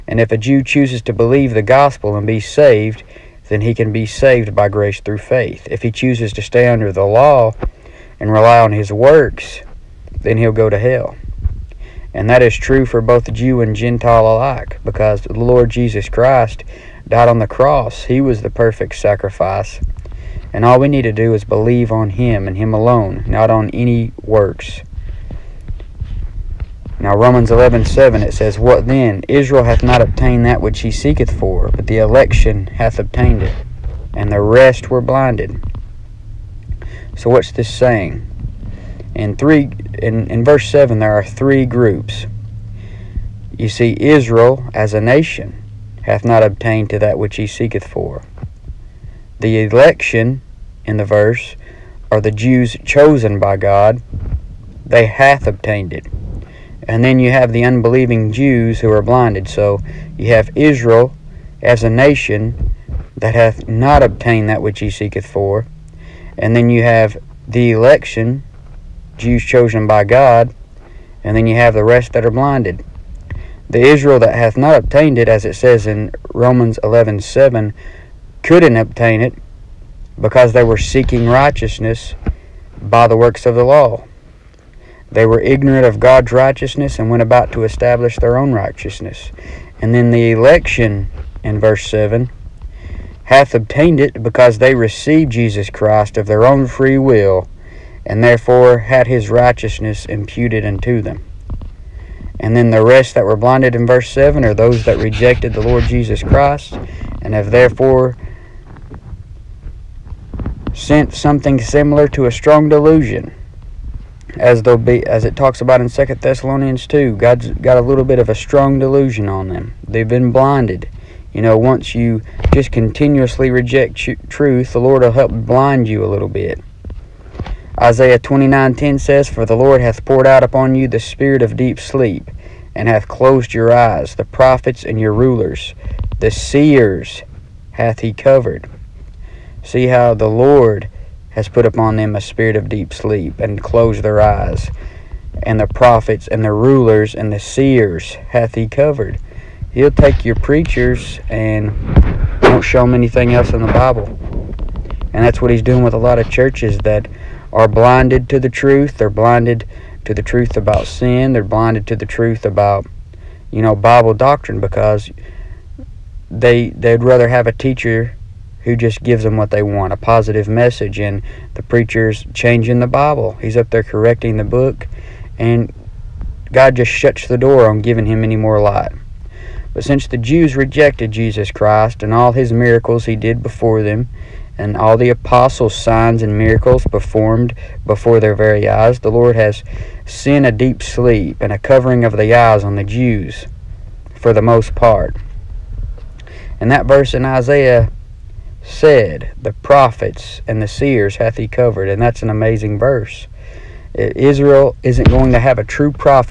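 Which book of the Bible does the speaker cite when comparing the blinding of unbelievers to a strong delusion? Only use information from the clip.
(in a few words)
Second Thessalonians.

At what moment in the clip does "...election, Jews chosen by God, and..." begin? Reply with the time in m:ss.
1:07.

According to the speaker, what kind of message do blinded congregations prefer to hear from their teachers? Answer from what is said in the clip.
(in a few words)
a positive message.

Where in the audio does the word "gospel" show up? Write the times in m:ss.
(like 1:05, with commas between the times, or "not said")
0:01.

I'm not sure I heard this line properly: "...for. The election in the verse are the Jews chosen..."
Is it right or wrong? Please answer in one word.
right.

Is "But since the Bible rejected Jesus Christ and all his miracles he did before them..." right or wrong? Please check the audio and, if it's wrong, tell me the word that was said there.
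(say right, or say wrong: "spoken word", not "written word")
wrong: "Jews", not "Bible".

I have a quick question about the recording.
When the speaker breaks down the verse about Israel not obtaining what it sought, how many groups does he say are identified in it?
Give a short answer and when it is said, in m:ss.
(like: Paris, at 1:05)
3, at 0:41.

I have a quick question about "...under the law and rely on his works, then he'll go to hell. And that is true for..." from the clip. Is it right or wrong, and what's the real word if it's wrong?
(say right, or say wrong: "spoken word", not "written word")
right.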